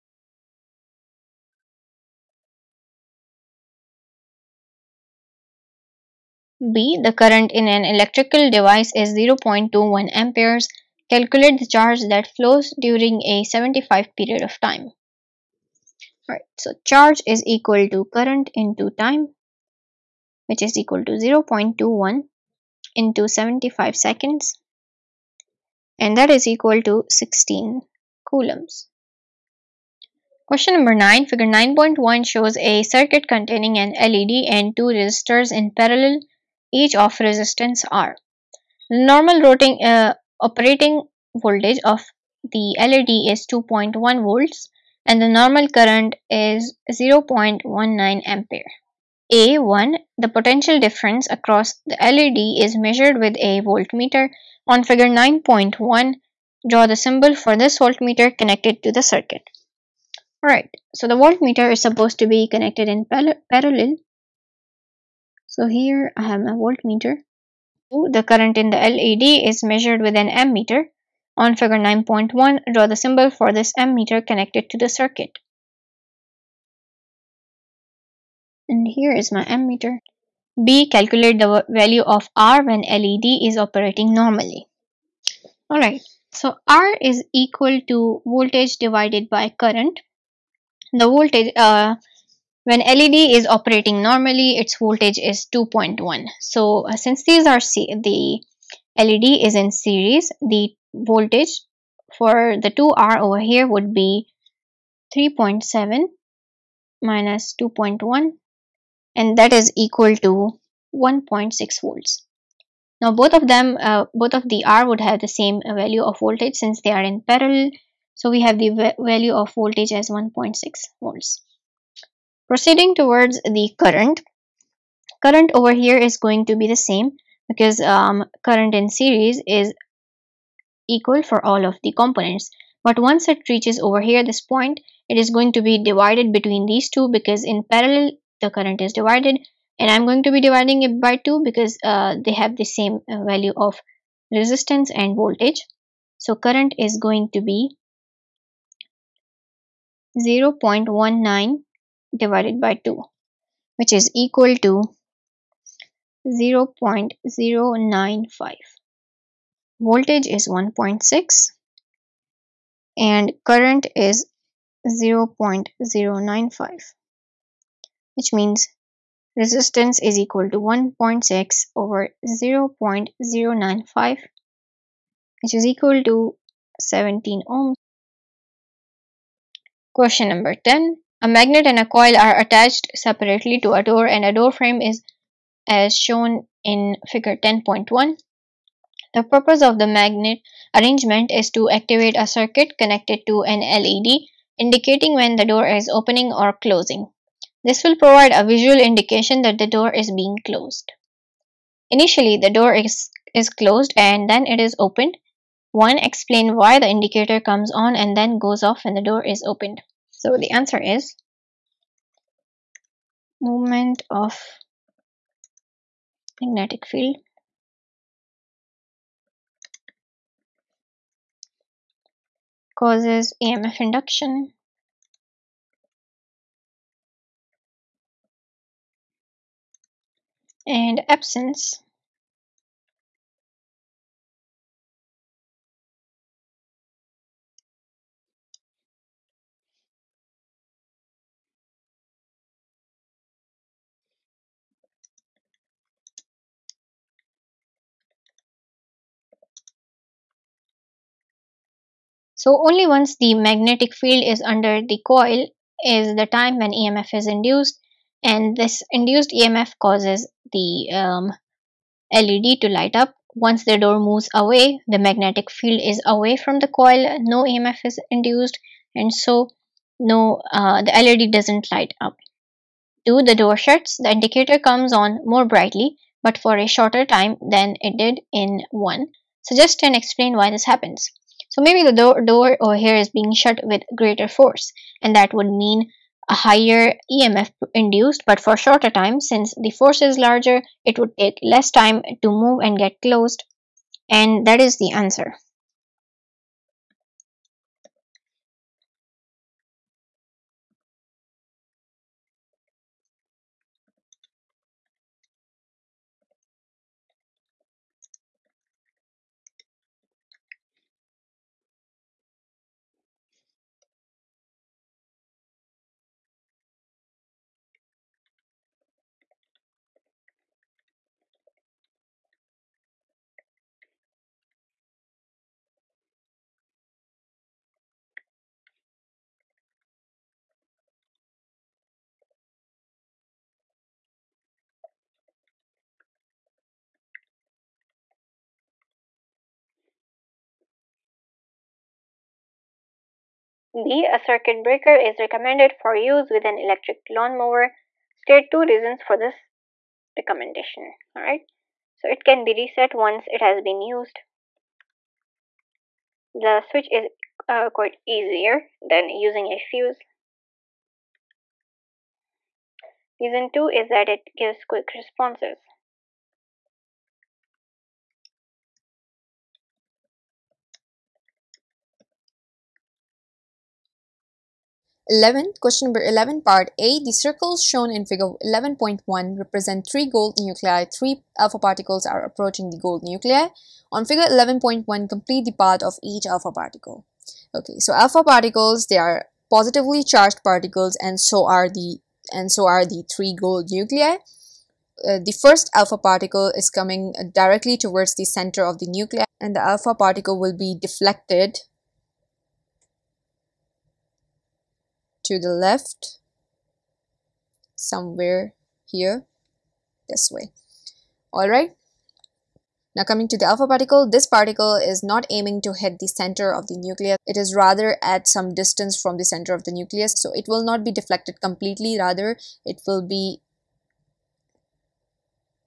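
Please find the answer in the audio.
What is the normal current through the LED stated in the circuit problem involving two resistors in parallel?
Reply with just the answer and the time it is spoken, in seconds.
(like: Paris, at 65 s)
0.19 ampere, at 46 s.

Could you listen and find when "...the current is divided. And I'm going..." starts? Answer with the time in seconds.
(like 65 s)
138 s.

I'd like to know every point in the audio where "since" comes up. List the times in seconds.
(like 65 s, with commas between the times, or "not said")
96 s, 116 s, 289 s.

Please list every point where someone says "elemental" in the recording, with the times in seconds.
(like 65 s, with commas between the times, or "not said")
not said.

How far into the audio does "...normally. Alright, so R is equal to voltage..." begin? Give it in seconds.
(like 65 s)
84 s.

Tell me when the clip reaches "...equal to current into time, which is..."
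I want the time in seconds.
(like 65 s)
17 s.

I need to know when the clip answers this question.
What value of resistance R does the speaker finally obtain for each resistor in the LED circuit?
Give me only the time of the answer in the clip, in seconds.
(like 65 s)
176 s.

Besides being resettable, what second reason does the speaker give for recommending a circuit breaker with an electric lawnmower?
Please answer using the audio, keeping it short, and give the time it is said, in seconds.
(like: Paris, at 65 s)
quick responses, at 364 s.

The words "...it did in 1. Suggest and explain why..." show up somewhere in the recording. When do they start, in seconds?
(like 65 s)
277 s.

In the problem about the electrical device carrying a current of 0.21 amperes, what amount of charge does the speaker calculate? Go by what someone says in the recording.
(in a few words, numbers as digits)
16 coulombs.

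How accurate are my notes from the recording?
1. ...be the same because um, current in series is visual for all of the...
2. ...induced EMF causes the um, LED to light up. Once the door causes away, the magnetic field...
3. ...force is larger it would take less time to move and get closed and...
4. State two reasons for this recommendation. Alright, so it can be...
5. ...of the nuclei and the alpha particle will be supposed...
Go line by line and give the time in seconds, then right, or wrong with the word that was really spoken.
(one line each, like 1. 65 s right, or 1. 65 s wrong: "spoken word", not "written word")
1. 126 s wrong: "equal", not "visual"
2. 258 s wrong: "moves", not "causes"
3. 289 s right
4. 348 s right
5. 398 s wrong: "deflected", not "supposed".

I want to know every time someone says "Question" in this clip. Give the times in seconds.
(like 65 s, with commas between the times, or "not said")
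30 s, 179 s, 375 s.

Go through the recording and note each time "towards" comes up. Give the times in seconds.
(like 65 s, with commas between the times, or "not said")
122 s, 397 s.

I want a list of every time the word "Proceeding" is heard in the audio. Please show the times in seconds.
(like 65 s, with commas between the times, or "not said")
122 s.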